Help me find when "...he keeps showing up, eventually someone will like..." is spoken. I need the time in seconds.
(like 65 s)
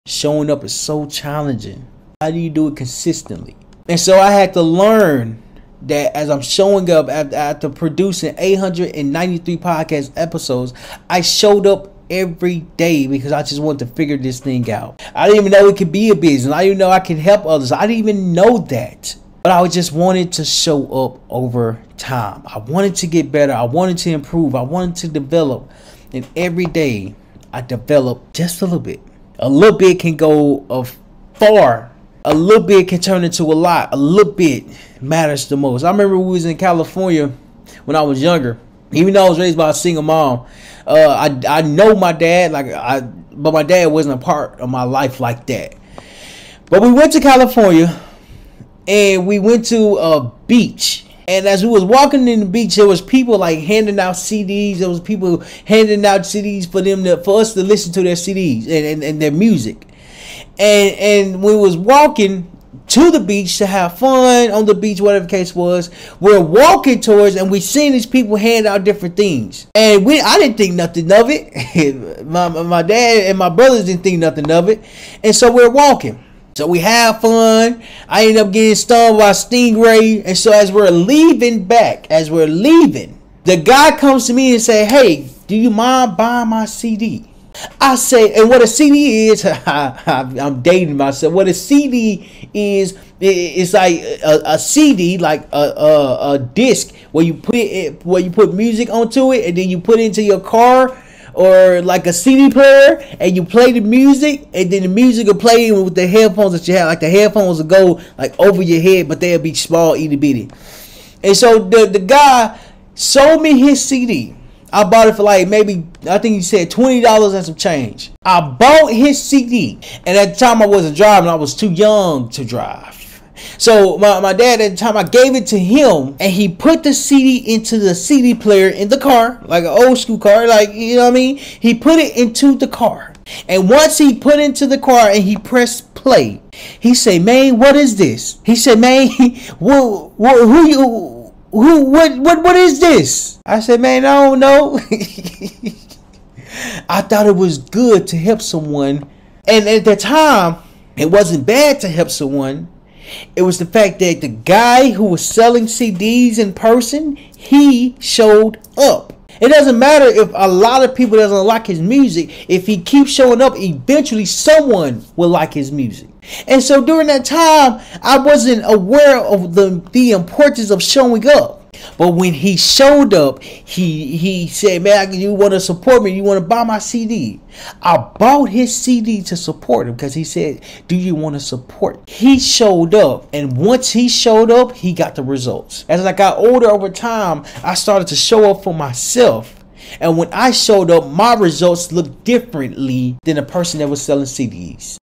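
162 s.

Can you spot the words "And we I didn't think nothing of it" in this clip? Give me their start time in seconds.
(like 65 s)
69 s.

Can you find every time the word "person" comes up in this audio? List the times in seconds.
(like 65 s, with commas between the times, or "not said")
156 s, 193 s.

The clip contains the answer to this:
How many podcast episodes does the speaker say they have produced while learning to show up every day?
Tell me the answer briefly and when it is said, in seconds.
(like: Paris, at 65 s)
893, at 8 s.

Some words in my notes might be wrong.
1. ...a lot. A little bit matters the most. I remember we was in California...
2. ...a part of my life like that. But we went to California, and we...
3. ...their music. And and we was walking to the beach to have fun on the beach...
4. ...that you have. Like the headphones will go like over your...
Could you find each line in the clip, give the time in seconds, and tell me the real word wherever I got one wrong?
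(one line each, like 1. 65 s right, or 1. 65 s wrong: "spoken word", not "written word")
1. 33 s right
2. 44 s right
3. 59 s right
4. 106 s right.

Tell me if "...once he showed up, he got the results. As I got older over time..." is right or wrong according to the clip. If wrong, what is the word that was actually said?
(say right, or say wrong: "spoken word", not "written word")
right.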